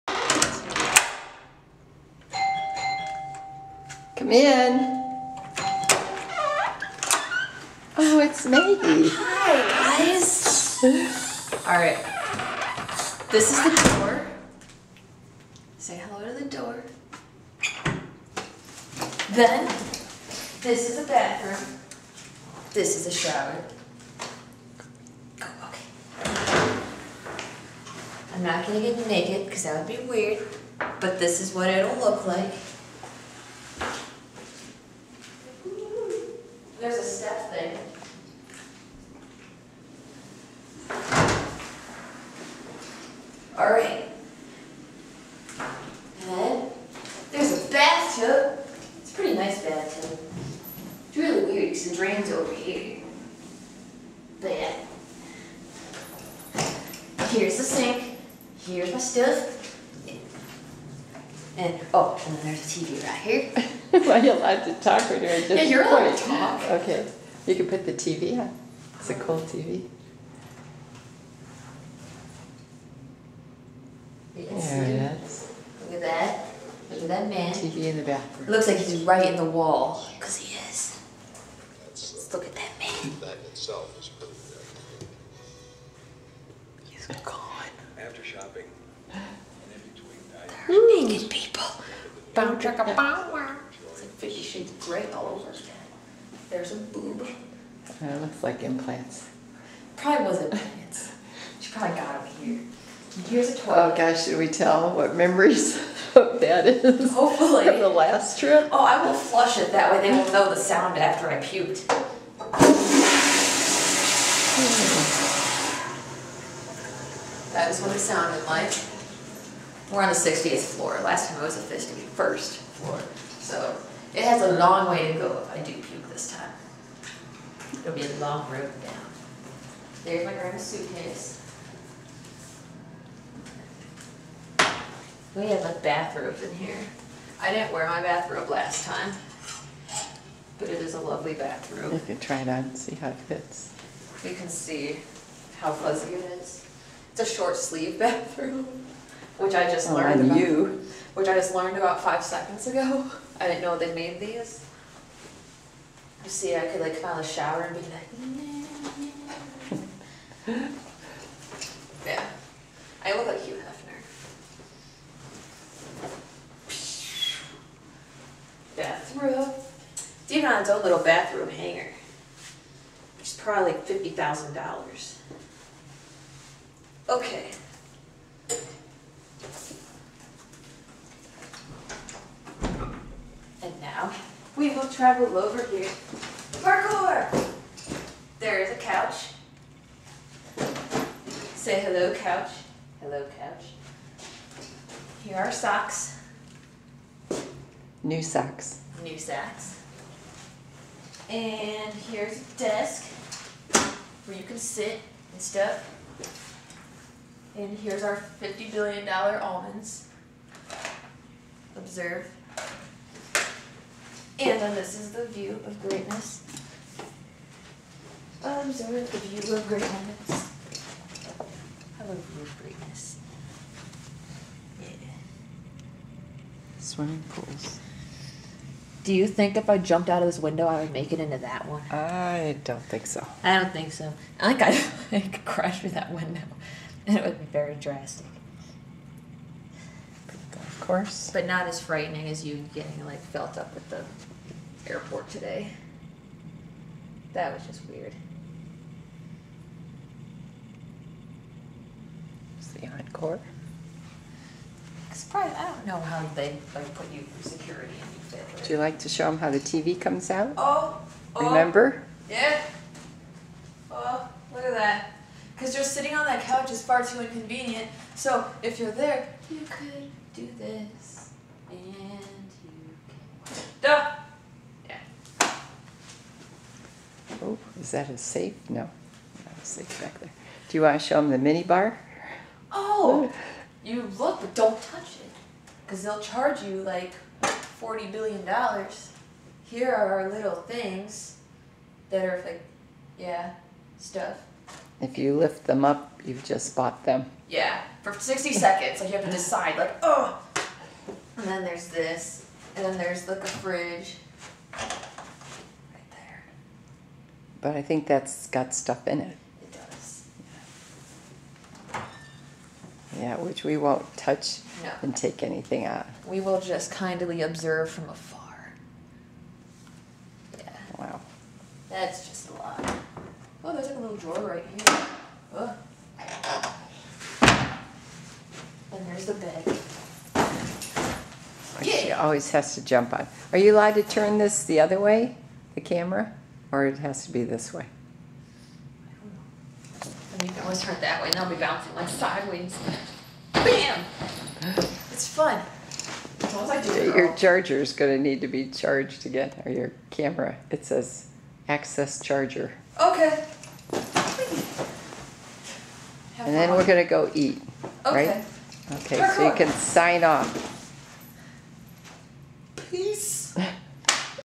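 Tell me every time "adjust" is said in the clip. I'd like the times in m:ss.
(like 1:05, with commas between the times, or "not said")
not said.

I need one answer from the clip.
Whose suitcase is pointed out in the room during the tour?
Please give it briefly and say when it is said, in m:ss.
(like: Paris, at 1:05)
grandma's, at 2:10.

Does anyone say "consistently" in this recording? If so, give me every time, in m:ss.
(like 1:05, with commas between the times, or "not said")
not said.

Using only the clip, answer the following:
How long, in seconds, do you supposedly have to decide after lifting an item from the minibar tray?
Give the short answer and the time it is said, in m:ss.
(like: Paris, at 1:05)
60 seconds, at 4:58.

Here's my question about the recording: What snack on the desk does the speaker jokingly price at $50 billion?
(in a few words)
almonds.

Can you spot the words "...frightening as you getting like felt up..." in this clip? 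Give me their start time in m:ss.
4:01.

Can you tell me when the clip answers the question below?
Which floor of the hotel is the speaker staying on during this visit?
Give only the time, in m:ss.
2:00.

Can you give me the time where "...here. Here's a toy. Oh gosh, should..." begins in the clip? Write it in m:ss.
1:42.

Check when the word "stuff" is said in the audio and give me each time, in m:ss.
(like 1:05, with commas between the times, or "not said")
0:58, 3:25, 4:53, 5:08.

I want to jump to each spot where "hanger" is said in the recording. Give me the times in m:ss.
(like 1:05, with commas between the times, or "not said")
2:51.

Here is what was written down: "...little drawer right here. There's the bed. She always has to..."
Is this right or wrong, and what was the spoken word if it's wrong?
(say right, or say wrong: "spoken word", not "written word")
right.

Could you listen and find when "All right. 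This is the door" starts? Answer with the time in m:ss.
0:11.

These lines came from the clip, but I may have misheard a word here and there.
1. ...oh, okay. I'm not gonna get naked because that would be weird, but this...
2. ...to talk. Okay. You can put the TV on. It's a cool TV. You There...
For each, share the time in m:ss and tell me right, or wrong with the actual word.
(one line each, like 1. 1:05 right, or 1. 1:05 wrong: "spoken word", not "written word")
1. 0:25 right
2. 1:06 right.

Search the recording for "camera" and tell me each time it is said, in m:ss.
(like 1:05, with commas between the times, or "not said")
5:35, 5:50.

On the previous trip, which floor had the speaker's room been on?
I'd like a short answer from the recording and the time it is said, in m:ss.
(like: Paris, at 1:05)
51st floor, at 2:01.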